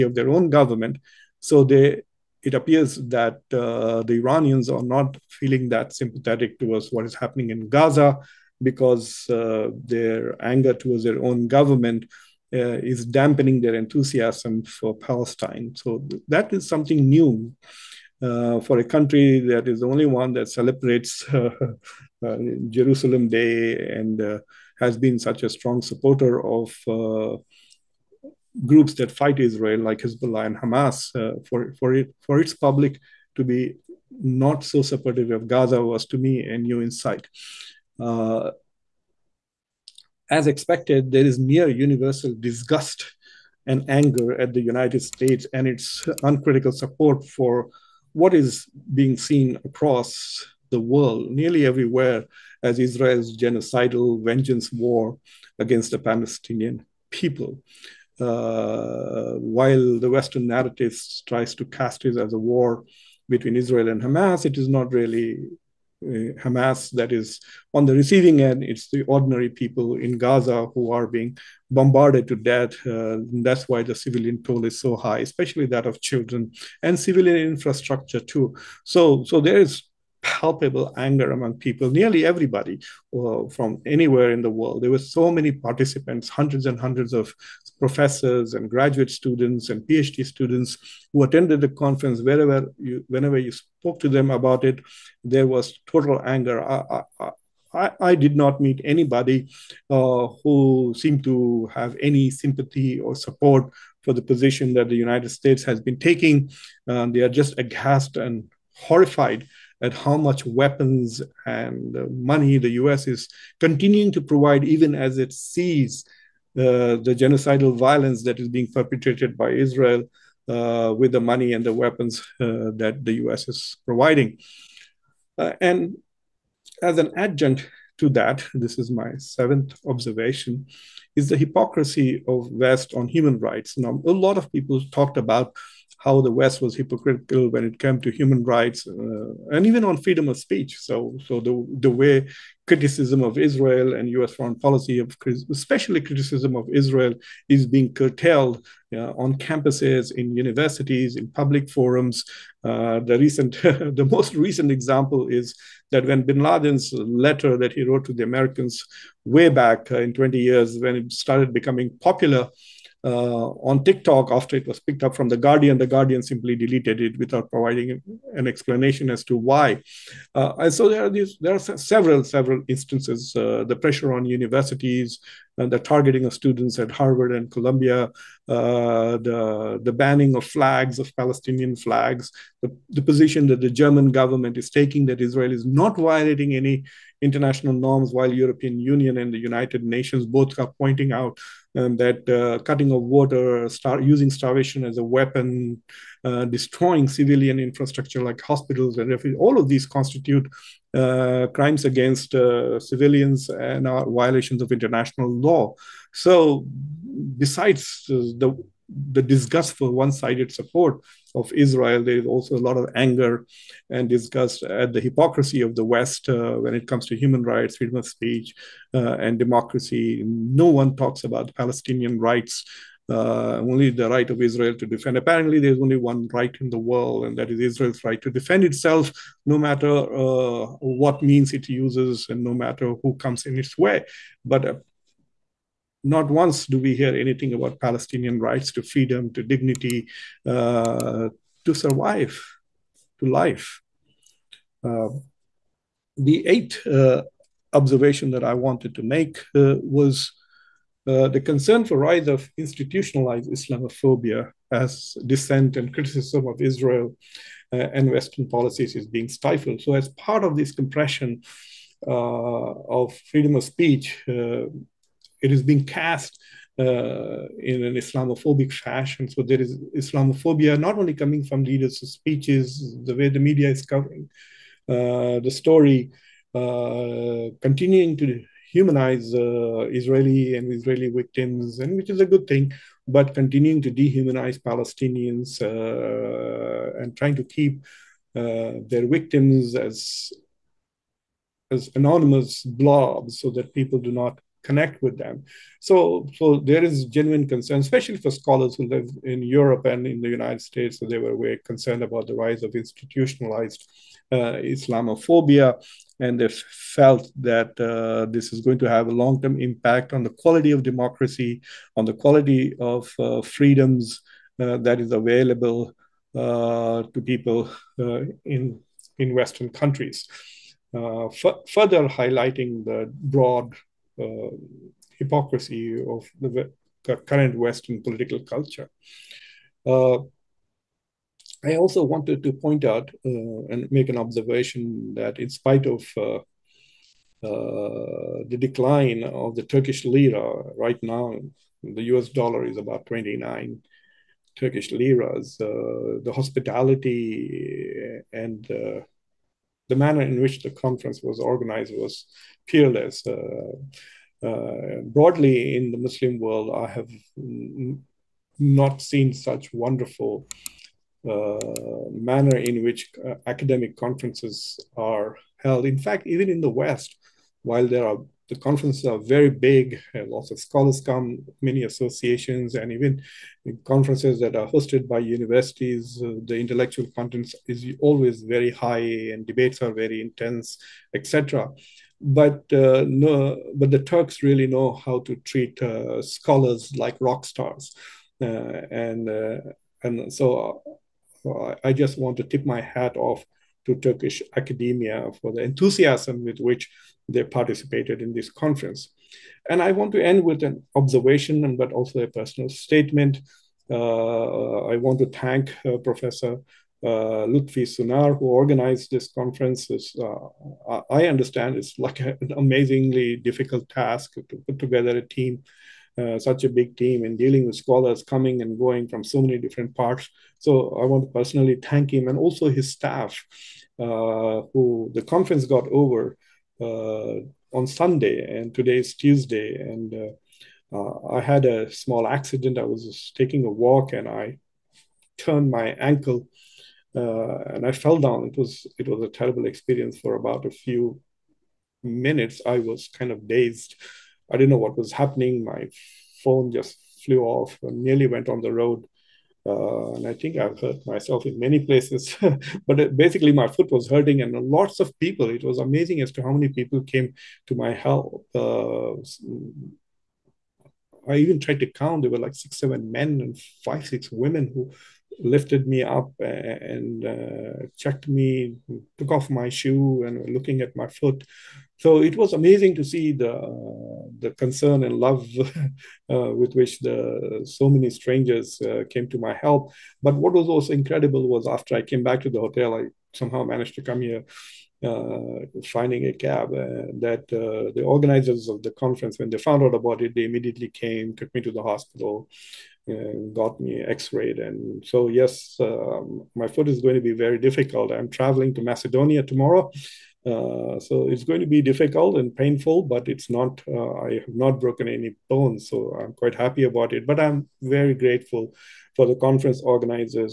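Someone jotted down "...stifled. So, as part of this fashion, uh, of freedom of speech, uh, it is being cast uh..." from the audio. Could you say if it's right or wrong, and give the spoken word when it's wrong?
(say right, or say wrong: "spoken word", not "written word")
wrong: "compression", not "fashion".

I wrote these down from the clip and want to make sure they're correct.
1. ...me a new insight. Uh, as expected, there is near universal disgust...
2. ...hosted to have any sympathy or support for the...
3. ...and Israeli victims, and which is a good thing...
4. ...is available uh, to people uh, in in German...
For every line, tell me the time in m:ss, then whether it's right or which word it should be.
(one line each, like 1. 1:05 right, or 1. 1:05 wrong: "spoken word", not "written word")
1. 0:36 right
2. 1:41 wrong: "seemed", not "hosted"
3. 4:40 right
4. 5:14 wrong: "Western", not "German".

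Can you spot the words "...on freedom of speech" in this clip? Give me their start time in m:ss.
2:19.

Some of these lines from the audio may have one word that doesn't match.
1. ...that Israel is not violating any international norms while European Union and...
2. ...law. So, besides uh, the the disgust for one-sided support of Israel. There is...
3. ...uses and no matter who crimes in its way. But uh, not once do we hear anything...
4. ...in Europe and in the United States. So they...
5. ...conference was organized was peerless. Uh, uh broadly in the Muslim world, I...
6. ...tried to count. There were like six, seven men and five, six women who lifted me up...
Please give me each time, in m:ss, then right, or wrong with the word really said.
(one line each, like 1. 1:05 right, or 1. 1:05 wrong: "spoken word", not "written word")
1. 3:05 right
2. 3:25 right
3. 3:51 wrong: "comes", not "crimes"
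4. 4:59 right
5. 5:50 right
6. 7:41 right.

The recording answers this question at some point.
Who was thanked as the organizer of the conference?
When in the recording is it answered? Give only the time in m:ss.
6:47.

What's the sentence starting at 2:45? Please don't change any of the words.
The Guardian simply deleted it without providing an explanation as to why.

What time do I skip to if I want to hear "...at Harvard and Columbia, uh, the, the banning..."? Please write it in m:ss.
2:56.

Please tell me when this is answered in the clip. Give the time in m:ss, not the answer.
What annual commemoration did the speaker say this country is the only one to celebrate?
0:22.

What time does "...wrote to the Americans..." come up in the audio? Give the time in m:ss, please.
2:37.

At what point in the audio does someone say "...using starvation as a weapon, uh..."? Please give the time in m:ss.
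3:13.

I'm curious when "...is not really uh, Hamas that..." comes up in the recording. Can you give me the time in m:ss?
1:04.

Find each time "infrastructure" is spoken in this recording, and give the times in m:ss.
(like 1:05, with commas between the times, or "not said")
1:17, 3:17.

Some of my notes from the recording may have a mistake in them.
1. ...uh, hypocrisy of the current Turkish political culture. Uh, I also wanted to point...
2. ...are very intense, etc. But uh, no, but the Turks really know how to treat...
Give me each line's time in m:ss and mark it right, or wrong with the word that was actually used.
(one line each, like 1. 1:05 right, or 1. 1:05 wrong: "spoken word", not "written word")
1. 5:24 wrong: "Western", not "Turkish"
2. 6:19 right.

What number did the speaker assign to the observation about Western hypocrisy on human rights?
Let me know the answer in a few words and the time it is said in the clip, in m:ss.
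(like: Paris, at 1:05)
7, at 2:09.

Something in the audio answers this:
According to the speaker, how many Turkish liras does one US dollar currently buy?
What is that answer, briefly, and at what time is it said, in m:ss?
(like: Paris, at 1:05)
29, at 5:43.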